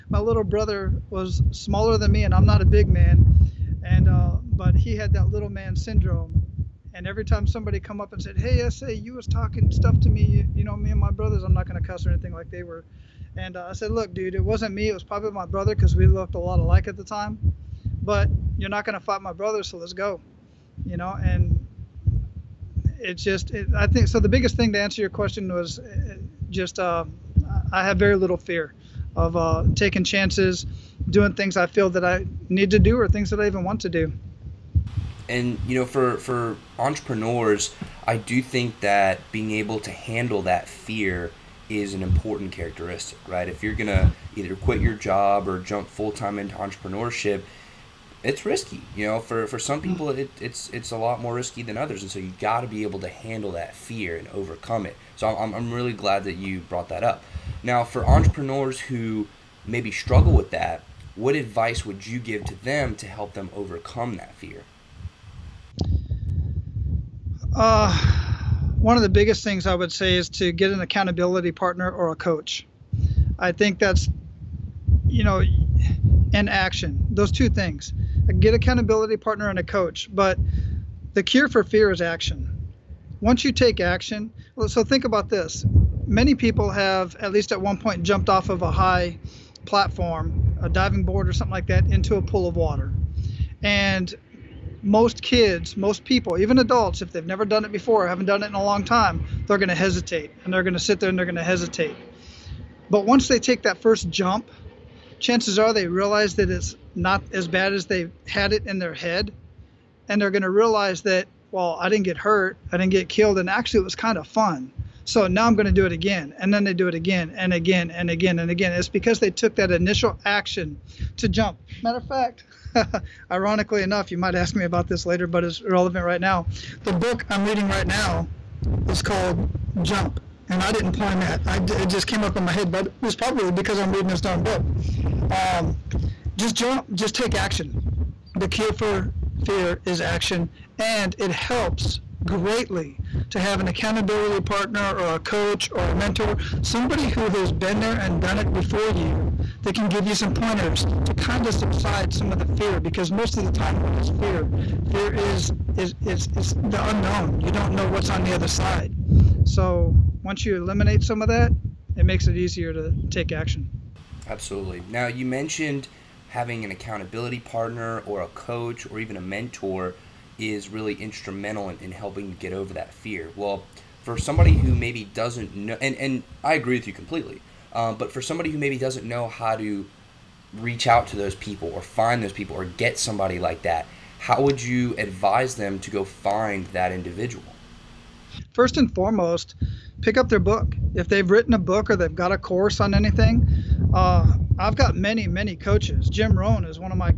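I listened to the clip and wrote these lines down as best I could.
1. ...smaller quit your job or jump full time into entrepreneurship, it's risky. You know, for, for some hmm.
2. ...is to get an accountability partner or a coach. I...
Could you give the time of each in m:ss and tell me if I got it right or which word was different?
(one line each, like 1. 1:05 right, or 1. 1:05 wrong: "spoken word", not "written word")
1. 0:44 wrong: "either", not "smaller"
2. 1:10 right.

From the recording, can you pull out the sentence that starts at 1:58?
It's because they took that initial action to jump.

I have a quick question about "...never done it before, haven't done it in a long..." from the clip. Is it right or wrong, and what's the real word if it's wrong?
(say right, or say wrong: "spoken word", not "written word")
right.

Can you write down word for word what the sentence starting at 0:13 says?
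And uh, I said, "Look, dude, it wasn't me.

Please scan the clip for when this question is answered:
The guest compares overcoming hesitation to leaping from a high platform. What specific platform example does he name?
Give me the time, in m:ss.
1:30.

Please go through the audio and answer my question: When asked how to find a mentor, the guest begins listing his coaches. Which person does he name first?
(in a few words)
Jim Rohn.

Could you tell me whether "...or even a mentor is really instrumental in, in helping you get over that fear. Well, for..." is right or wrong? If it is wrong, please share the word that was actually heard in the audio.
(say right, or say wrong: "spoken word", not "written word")
right.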